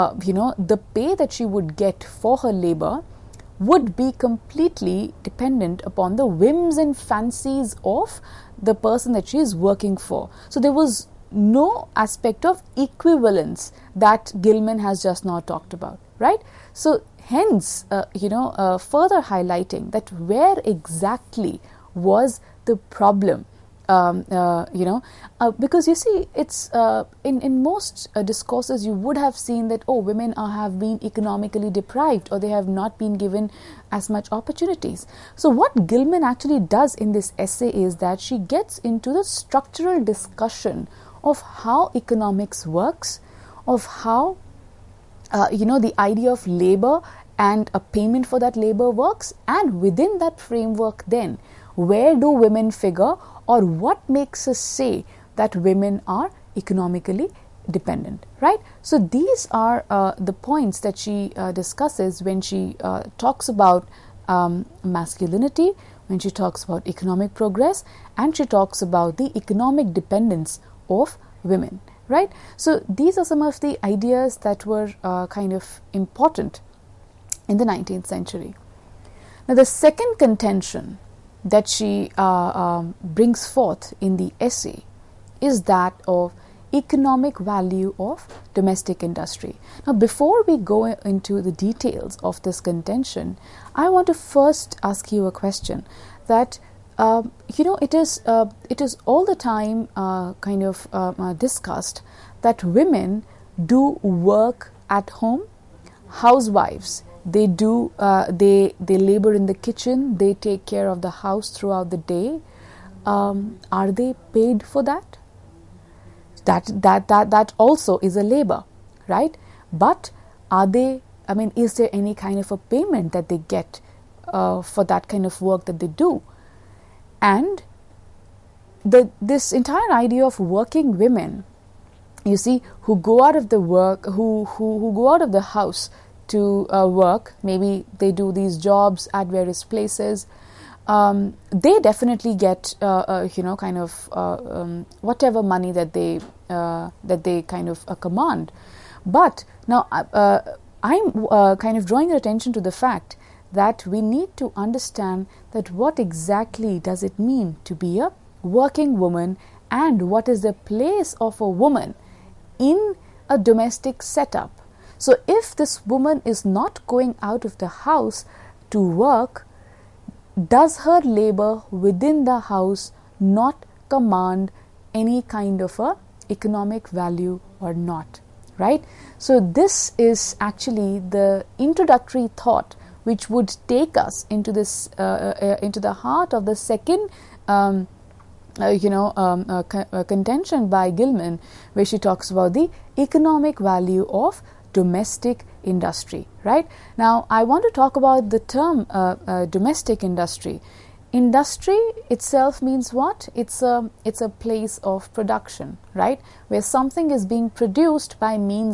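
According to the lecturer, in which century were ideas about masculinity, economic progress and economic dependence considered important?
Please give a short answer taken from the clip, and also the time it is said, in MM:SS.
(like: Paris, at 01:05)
19th century, at 01:17.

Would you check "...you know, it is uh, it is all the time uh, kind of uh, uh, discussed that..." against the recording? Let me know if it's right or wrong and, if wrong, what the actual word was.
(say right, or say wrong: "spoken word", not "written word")
right.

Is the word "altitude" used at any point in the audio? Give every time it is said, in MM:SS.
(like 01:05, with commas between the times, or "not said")
not said.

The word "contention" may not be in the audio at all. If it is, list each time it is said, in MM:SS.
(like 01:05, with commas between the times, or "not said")
01:20, 01:32, 03:10.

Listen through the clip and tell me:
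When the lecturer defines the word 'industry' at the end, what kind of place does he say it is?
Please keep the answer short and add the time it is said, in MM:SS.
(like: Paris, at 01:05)
A place of production, at 03:24.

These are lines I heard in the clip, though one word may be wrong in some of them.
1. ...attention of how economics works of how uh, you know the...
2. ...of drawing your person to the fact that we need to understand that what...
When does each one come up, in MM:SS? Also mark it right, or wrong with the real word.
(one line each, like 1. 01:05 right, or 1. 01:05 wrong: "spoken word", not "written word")
1. 00:40 wrong: "discussion", not "attention"
2. 02:31 wrong: "attention", not "person".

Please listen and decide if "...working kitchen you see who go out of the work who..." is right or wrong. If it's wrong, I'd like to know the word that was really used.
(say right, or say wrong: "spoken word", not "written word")
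wrong: "women", not "kitchen".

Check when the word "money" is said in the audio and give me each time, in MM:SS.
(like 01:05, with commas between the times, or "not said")
02:25.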